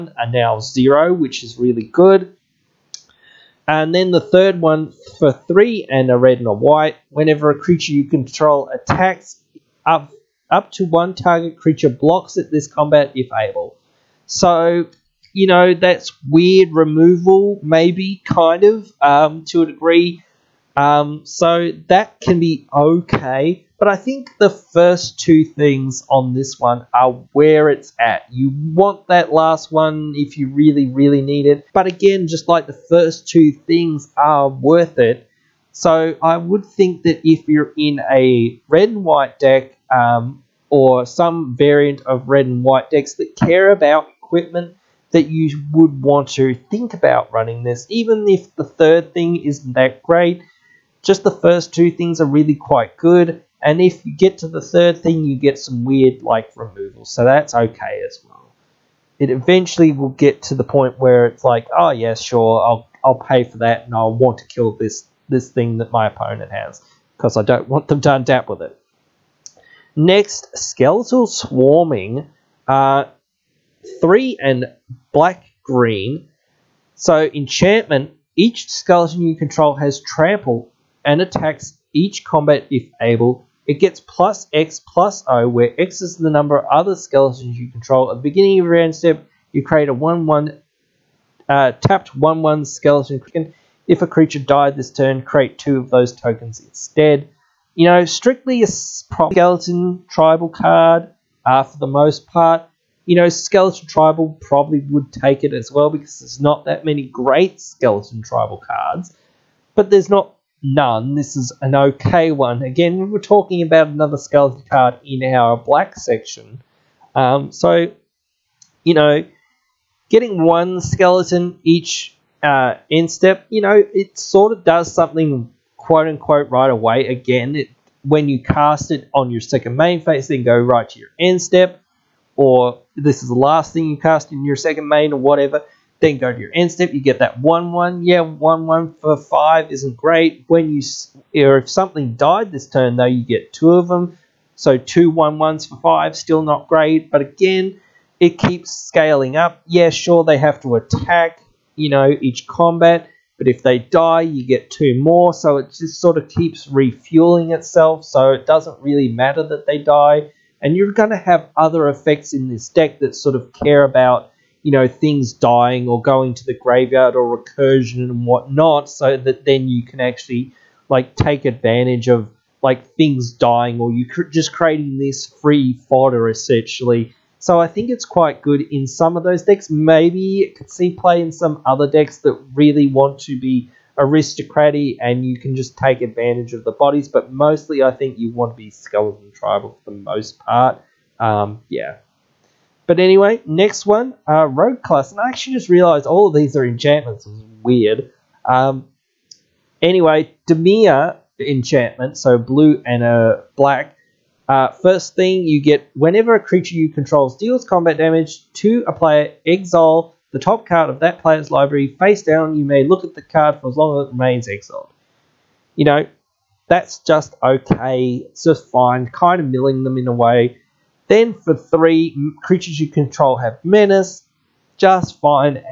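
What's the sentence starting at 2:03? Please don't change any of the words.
you know, it sort of does something quote unquote right away.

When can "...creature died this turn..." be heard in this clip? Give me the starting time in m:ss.
1:34.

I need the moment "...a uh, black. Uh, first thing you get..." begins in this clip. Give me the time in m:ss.
3:23.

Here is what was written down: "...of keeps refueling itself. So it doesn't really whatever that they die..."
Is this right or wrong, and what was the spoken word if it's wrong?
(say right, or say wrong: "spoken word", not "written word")
wrong: "matter", not "whatever".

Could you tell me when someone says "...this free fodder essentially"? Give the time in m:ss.
2:54.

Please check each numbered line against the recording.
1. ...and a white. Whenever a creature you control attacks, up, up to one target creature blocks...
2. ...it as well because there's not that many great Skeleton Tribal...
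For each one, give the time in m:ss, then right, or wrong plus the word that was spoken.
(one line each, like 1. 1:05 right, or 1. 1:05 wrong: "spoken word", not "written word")
1. 0:06 right
2. 1:45 right.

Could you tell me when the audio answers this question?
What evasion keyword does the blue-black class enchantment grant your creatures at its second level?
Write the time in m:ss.
3:43.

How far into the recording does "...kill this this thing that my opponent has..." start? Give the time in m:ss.
1:04.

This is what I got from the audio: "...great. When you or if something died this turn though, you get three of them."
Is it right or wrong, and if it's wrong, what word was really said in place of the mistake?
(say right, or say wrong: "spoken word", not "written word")
wrong: "two", not "three".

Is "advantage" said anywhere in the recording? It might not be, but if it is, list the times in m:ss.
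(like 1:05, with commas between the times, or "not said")
2:51, 3:06.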